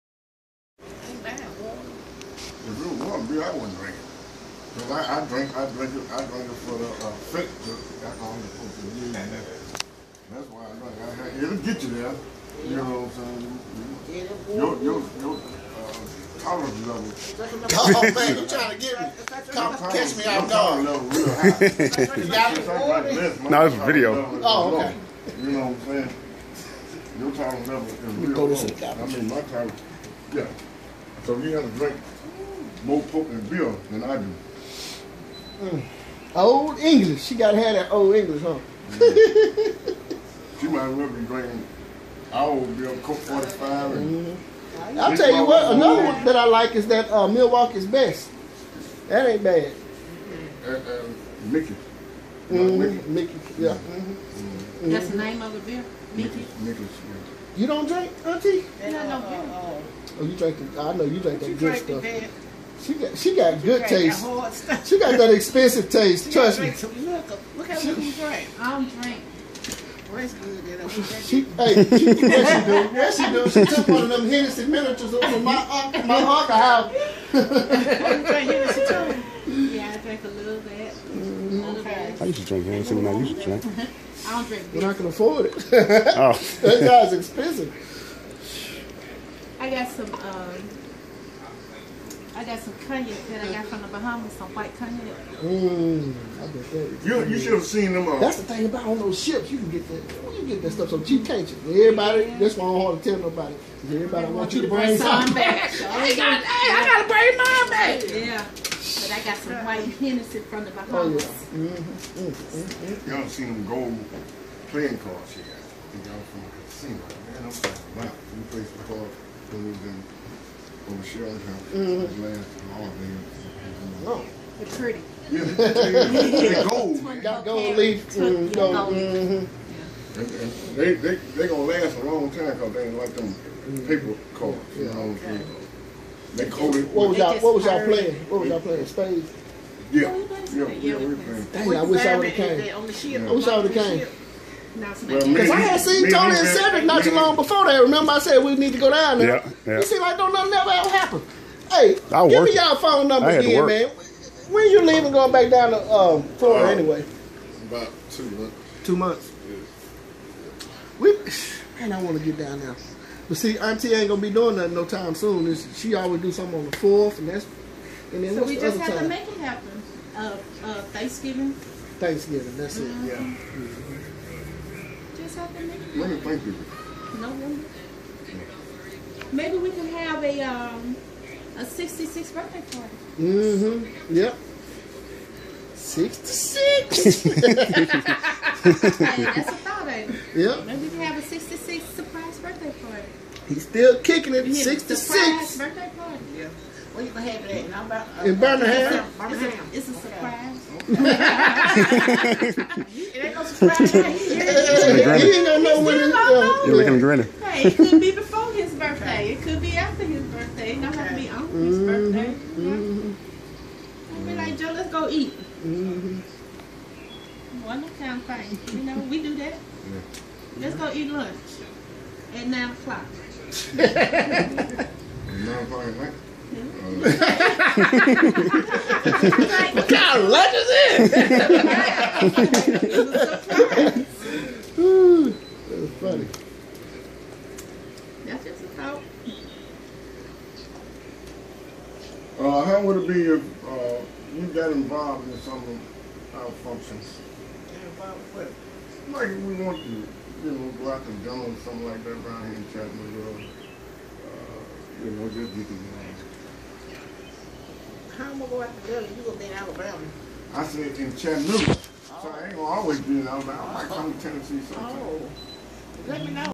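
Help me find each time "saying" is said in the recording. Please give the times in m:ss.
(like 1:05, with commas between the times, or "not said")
0:13, 0:25, 2:15.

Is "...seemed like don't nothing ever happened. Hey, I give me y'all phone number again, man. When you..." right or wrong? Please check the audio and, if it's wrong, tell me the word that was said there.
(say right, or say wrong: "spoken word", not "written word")
right.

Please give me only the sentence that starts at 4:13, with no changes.
Uh, you know, just get together how am I going out to Dillon?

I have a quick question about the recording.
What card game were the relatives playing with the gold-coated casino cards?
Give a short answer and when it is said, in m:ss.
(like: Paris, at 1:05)
Spades, at 2:18.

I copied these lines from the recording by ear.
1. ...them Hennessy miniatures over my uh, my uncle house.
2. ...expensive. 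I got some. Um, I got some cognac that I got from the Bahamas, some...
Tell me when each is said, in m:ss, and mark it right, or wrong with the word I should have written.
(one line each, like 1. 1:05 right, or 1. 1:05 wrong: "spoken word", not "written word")
1. 1:14 right
2. 1:27 right.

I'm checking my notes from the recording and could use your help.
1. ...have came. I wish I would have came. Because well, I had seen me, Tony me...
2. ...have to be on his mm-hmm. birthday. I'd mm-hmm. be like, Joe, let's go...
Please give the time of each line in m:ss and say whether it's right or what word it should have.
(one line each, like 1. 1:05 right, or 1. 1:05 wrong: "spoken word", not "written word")
1. 2:22 right
2. 3:30 right.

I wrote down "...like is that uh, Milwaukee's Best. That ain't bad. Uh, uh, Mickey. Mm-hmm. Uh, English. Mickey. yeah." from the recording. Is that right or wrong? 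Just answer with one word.
wrong.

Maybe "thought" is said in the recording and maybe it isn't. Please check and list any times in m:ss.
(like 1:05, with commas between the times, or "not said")
3:09, 3:58.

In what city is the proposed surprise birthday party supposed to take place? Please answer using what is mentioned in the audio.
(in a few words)
Birmingham.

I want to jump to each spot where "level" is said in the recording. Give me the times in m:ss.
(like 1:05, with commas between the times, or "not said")
0:16, 0:27.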